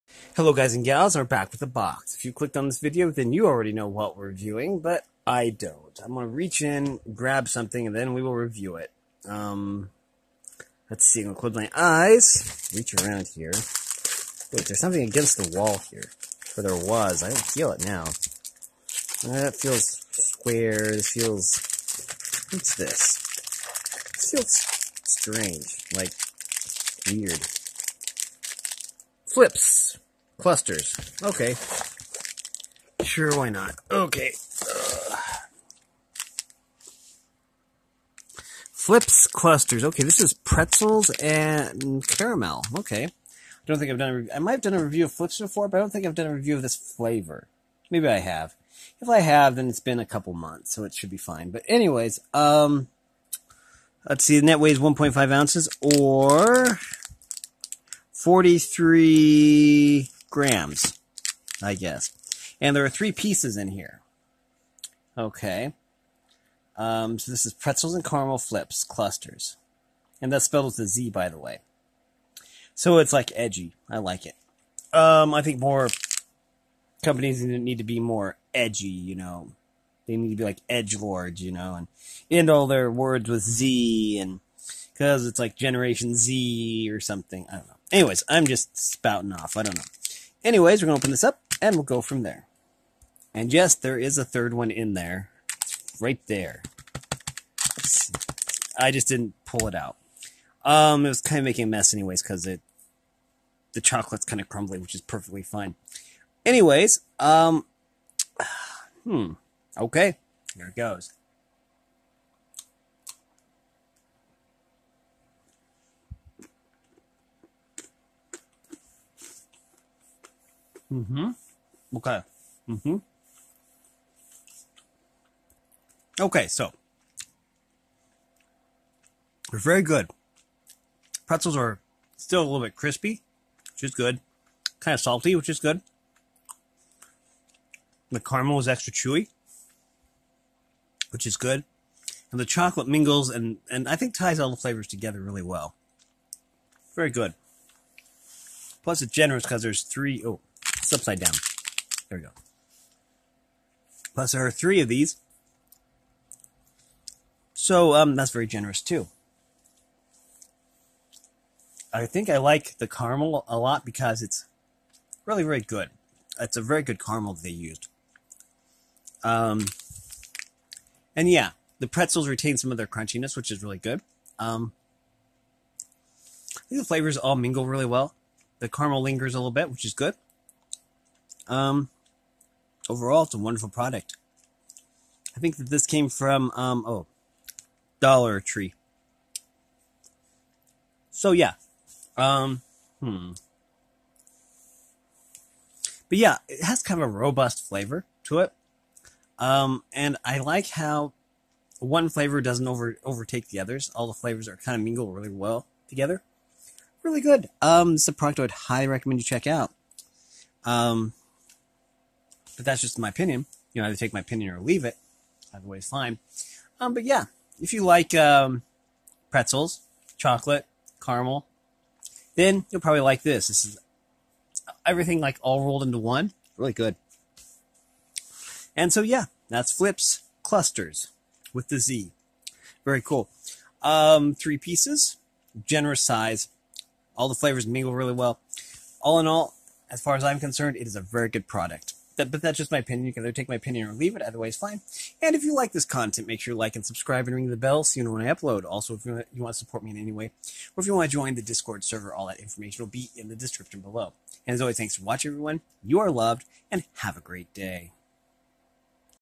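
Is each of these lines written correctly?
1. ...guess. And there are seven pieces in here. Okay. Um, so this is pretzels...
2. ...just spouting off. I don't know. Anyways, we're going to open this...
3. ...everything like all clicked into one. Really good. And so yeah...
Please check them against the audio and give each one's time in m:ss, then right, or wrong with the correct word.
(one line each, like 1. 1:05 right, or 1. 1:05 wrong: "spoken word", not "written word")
1. 1:01 wrong: "three", not "seven"
2. 1:28 right
3. 3:44 wrong: "rolled", not "clicked".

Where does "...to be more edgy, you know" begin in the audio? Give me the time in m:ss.
1:17.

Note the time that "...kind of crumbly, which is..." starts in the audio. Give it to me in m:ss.
1:44.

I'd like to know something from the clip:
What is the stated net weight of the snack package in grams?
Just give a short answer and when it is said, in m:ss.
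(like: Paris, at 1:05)
43 grams, at 0:58.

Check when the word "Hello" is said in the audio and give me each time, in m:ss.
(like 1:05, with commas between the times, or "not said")
0:00.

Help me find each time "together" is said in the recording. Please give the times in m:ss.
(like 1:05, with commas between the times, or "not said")
2:24, 3:25.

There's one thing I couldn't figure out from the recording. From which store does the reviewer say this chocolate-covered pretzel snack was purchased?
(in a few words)
Dollar Tree.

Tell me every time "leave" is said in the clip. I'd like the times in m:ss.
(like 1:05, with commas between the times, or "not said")
3:34, 4:03.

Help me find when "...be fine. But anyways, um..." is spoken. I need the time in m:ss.
0:51.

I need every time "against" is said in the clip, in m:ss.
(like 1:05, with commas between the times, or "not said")
0:15.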